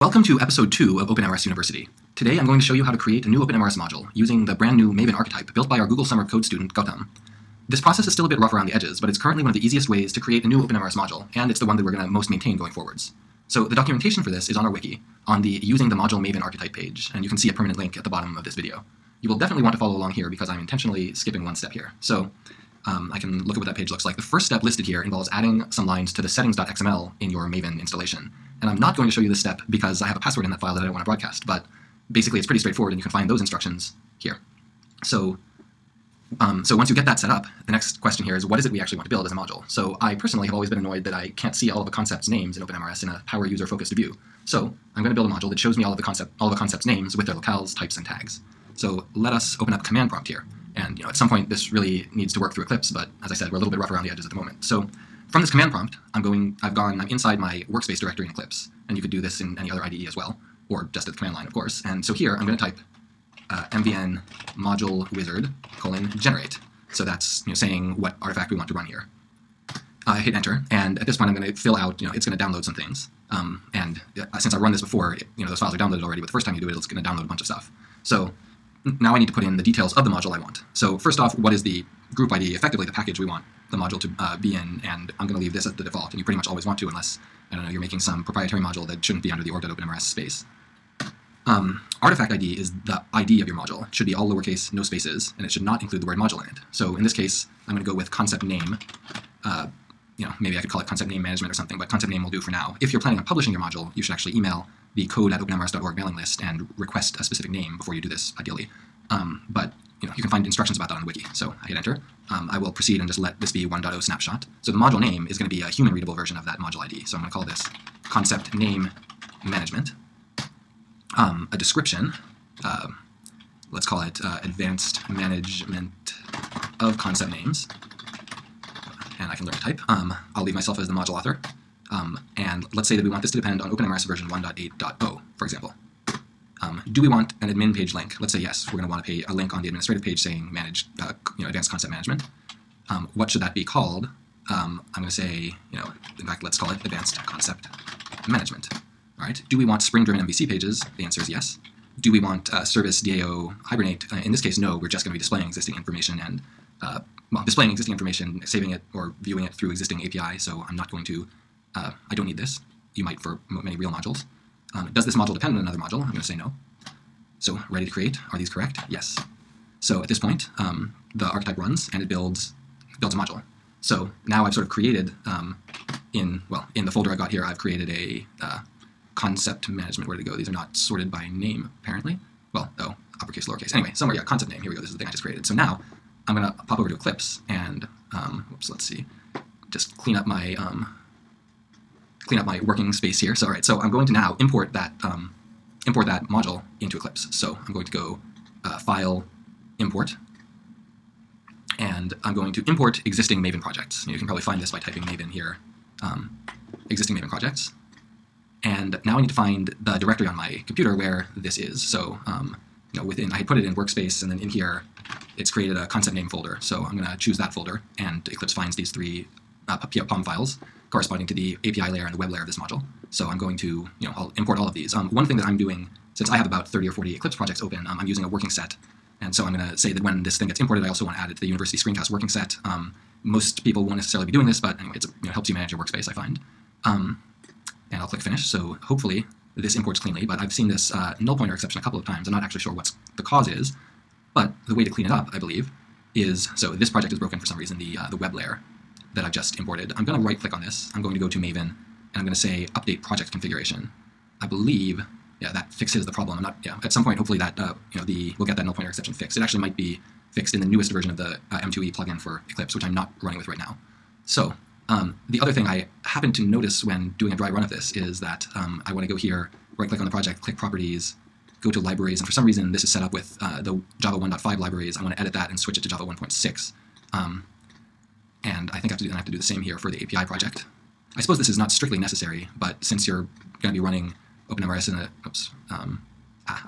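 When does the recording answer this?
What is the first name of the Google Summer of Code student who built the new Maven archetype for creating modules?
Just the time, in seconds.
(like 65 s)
6 s.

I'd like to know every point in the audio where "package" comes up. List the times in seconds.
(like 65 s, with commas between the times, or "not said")
82 s.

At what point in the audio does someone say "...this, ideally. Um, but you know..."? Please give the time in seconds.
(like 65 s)
108 s.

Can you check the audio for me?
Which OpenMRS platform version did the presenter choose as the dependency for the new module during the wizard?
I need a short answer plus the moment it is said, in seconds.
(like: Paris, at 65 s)
1.8.0, at 134 s.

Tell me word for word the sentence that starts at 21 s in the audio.
So um, I can look at what that page looks like.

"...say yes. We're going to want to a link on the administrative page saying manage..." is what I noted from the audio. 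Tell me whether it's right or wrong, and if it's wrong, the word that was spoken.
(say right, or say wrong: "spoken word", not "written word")
right.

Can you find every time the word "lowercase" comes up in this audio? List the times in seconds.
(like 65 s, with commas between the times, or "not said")
94 s, 183 s.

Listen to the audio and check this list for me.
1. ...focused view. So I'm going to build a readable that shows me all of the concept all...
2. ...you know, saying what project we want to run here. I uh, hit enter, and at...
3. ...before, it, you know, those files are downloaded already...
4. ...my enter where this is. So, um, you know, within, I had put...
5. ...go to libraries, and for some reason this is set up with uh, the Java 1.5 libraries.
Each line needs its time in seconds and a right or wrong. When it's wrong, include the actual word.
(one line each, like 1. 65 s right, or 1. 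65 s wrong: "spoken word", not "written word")
1. 43 s wrong: "module", not "readable"
2. 67 s wrong: "artifact", not "project"
3. 74 s right
4. 210 s wrong: "computer", not "enter"
5. 271 s right.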